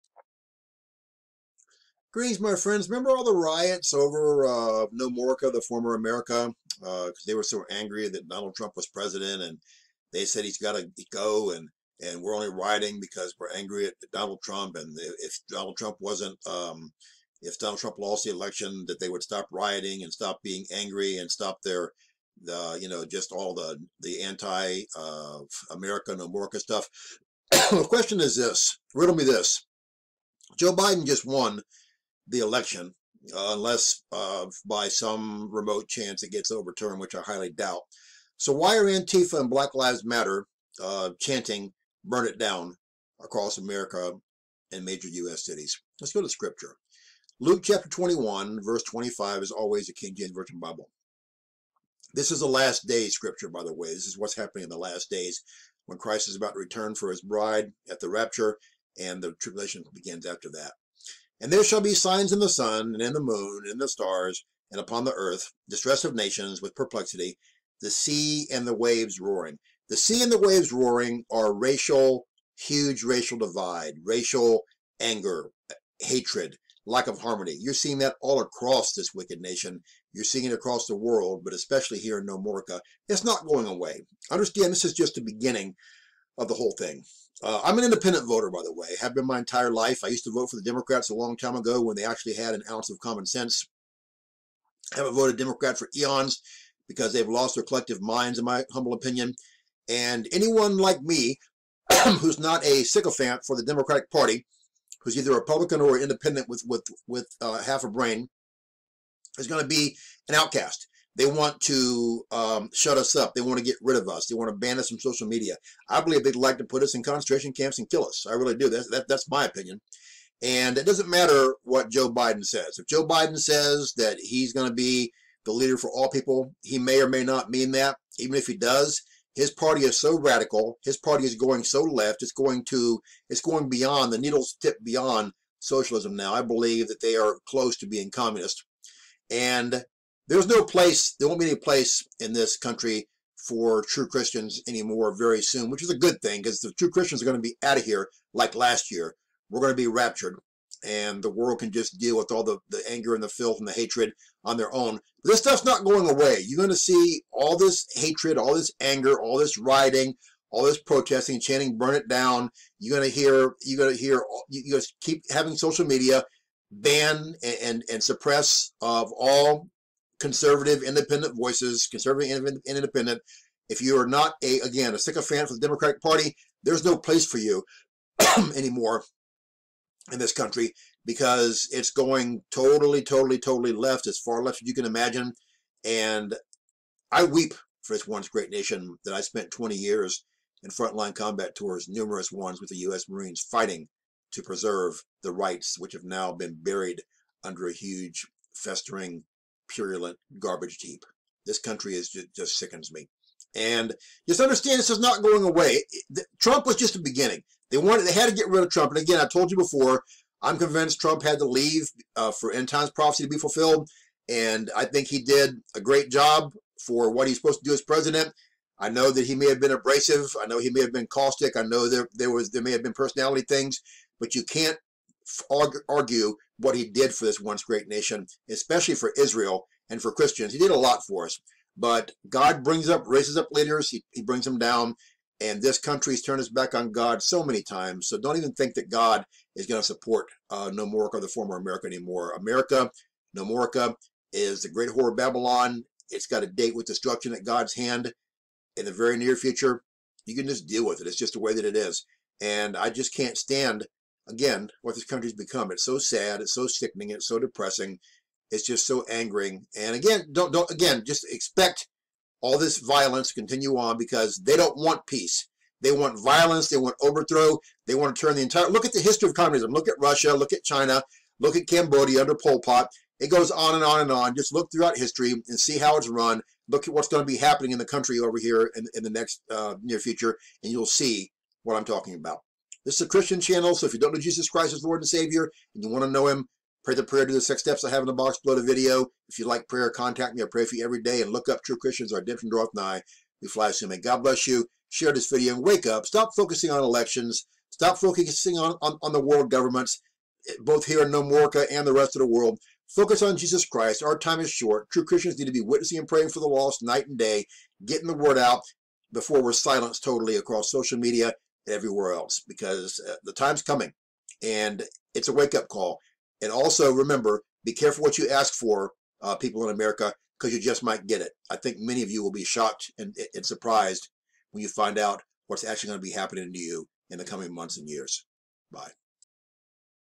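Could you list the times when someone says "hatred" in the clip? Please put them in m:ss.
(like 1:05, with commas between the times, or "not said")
1:15, 2:33, 2:37.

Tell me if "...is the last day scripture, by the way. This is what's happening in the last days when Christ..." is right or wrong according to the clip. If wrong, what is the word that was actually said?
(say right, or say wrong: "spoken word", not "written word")
right.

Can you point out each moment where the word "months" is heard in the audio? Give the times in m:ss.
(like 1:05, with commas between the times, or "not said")
5:27.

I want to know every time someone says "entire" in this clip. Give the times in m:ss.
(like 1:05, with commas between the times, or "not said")
1:29, 4:28.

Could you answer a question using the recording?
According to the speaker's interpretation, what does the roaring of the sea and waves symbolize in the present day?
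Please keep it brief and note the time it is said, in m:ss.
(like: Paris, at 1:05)
Racial divide, at 1:12.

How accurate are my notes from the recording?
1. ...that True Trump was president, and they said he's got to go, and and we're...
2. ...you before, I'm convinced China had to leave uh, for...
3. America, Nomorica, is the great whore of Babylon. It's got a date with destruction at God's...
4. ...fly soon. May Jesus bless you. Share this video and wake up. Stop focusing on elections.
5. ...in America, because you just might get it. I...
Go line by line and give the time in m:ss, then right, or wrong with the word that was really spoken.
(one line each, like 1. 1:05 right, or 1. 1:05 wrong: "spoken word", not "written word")
1. 0:08 wrong: "Donald", not "True"
2. 3:29 wrong: "Trump", not "China"
3. 4:02 right
4. 4:53 wrong: "God", not "Jesus"
5. 5:19 right.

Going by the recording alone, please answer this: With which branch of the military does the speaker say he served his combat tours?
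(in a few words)
U.S. Marines.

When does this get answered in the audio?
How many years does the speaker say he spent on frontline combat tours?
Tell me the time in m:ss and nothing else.
3:09.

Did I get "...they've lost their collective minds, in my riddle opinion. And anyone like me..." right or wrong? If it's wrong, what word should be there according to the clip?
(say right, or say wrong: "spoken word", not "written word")
wrong: "humble", not "riddle".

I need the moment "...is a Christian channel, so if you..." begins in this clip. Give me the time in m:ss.
4:42.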